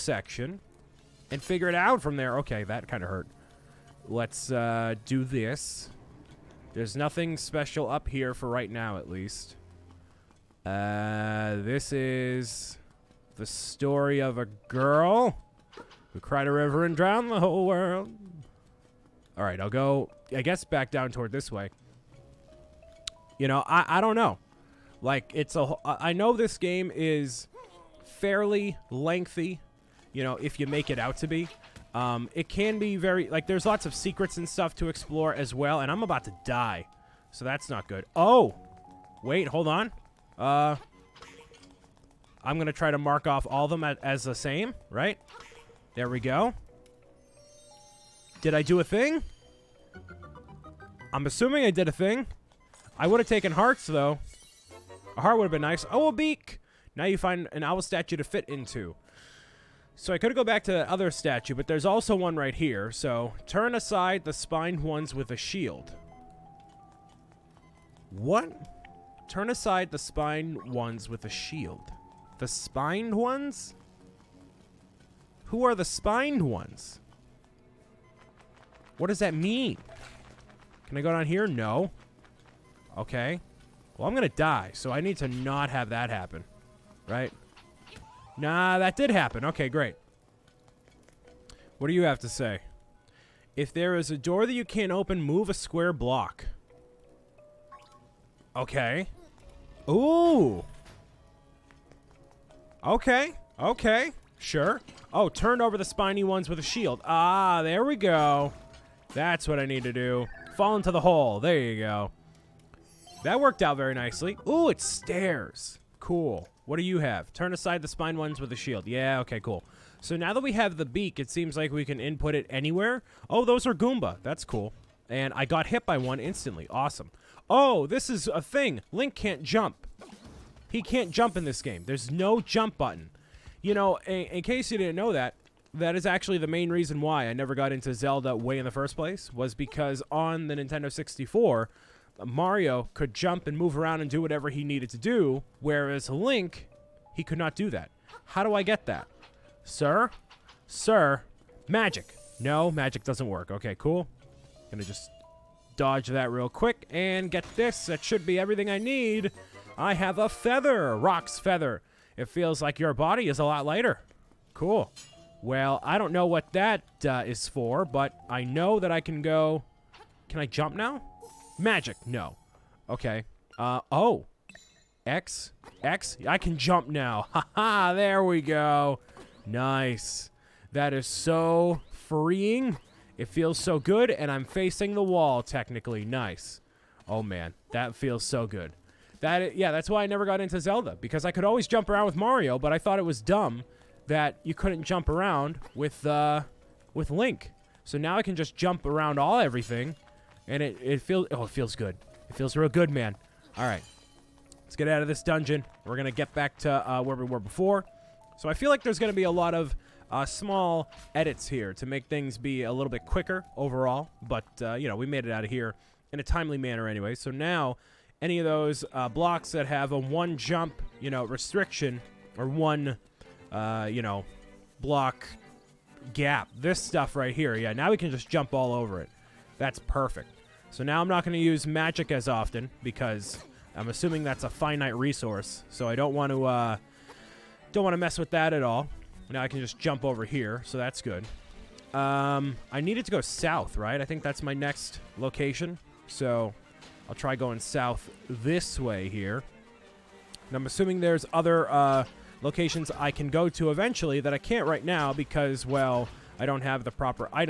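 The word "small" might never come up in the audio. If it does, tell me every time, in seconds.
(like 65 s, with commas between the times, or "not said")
210 s.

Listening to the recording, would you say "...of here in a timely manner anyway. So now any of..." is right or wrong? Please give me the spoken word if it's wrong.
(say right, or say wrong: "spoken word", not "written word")
right.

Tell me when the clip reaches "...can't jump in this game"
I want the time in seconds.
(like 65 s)
130 s.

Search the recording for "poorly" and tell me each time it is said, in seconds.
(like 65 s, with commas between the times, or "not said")
not said.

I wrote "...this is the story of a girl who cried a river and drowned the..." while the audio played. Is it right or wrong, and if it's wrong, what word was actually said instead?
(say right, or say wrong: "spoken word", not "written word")
right.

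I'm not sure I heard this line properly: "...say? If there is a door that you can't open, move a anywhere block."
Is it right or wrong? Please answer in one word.
wrong.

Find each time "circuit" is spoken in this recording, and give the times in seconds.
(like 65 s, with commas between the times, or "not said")
not said.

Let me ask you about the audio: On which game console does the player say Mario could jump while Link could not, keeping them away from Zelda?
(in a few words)
Nintendo 64.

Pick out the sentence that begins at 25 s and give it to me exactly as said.
Like, it's a, I know this game is fairly lengthy, you know, if you make it out to be.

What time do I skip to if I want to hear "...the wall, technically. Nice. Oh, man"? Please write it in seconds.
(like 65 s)
184 s.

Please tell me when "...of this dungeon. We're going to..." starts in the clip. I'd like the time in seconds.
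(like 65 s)
205 s.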